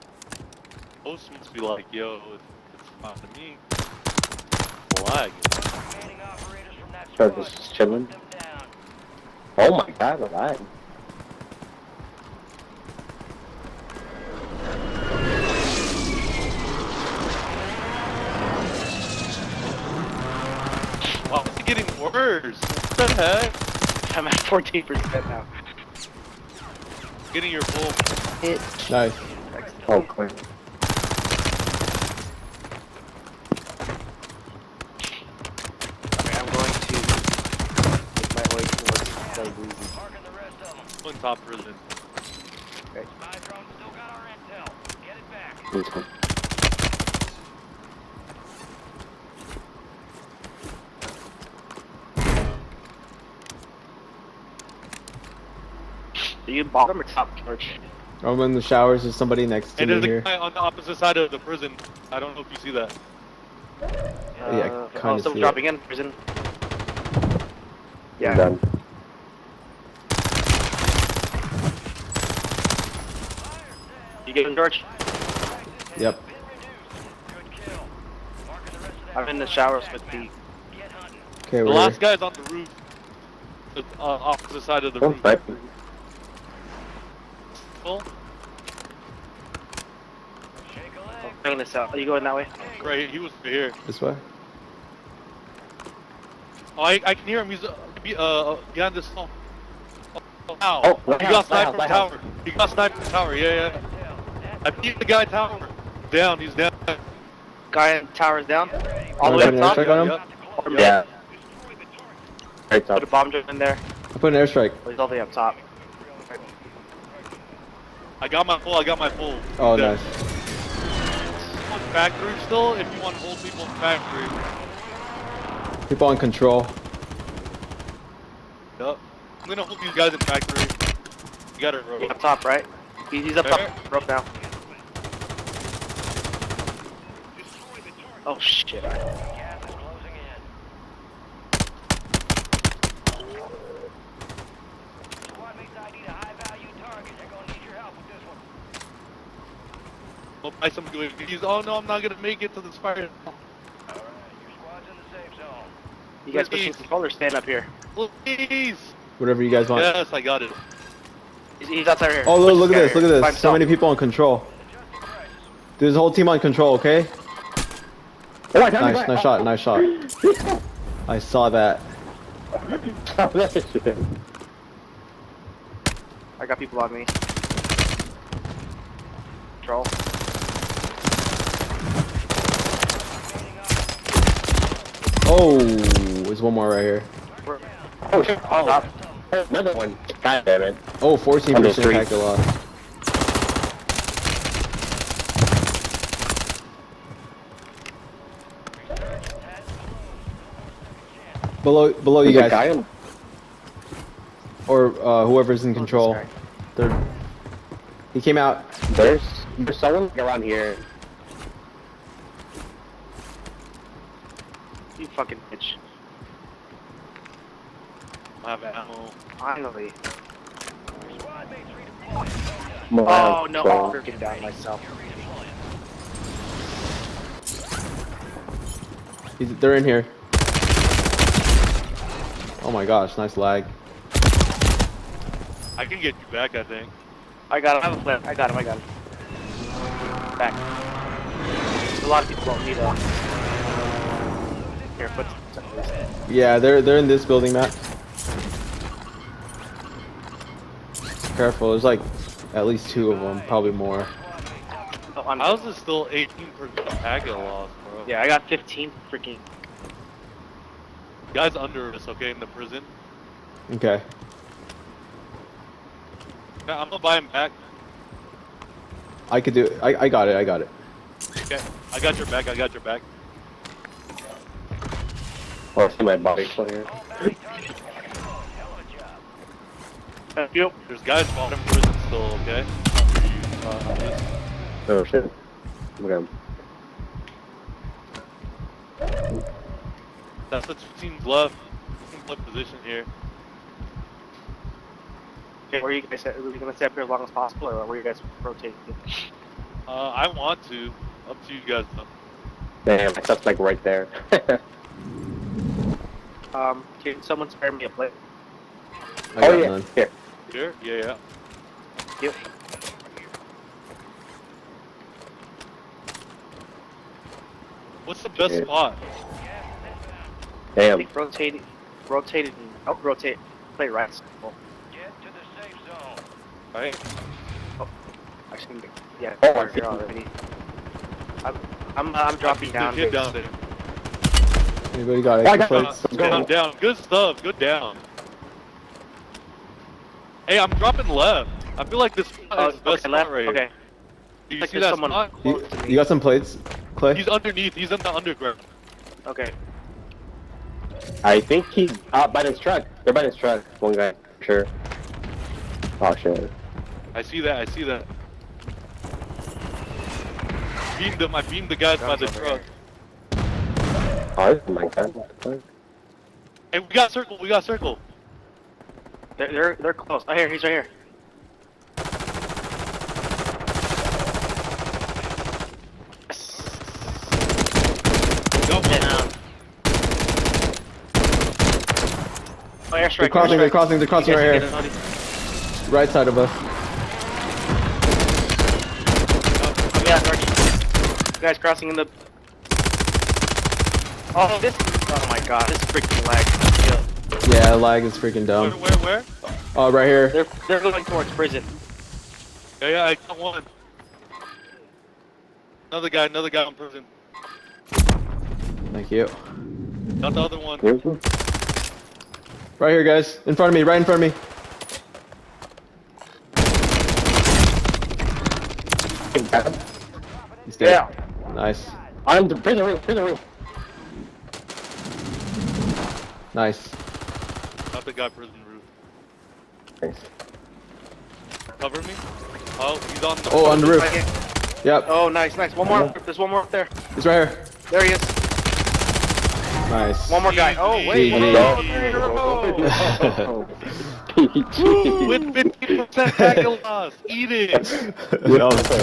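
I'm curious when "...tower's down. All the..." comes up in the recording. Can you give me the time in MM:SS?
01:48.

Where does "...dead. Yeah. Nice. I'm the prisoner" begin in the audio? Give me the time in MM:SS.
07:00.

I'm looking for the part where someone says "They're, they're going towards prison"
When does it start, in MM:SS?
06:40.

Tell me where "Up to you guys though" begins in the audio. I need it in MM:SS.
05:01.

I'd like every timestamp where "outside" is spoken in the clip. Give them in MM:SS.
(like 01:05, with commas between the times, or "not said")
02:41.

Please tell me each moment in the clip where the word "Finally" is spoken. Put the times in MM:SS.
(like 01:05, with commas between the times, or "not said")
03:39.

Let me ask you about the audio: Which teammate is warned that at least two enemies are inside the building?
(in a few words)
Matt.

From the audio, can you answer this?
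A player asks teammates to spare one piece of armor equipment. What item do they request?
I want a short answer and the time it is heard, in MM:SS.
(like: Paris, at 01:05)
A plate, at 05:07.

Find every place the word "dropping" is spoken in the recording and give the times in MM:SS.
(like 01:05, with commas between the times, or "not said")
01:05, 05:32, 05:40.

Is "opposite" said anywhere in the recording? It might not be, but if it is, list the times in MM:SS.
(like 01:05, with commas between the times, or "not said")
01:00, 01:24.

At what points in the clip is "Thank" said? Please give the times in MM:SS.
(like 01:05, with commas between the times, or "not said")
04:40, 06:48, 07:09.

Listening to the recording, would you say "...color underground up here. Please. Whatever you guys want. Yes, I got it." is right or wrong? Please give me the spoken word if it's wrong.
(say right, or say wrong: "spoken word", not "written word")
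wrong: "stand", not "underground".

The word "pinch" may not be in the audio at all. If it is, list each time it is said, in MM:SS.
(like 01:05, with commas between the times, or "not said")
not said.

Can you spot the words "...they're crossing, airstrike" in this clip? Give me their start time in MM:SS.
06:23.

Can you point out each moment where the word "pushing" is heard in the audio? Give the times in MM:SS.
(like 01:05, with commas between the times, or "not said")
02:36.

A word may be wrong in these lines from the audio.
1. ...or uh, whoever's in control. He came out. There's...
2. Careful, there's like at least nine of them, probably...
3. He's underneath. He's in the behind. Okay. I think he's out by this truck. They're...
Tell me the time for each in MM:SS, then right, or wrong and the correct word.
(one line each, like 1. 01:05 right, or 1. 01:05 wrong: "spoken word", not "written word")
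1. 03:24 right
2. 04:11 wrong: "two", not "nine"
3. 05:47 wrong: "underground", not "behind".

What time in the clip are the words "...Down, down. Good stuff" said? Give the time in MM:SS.
05:36.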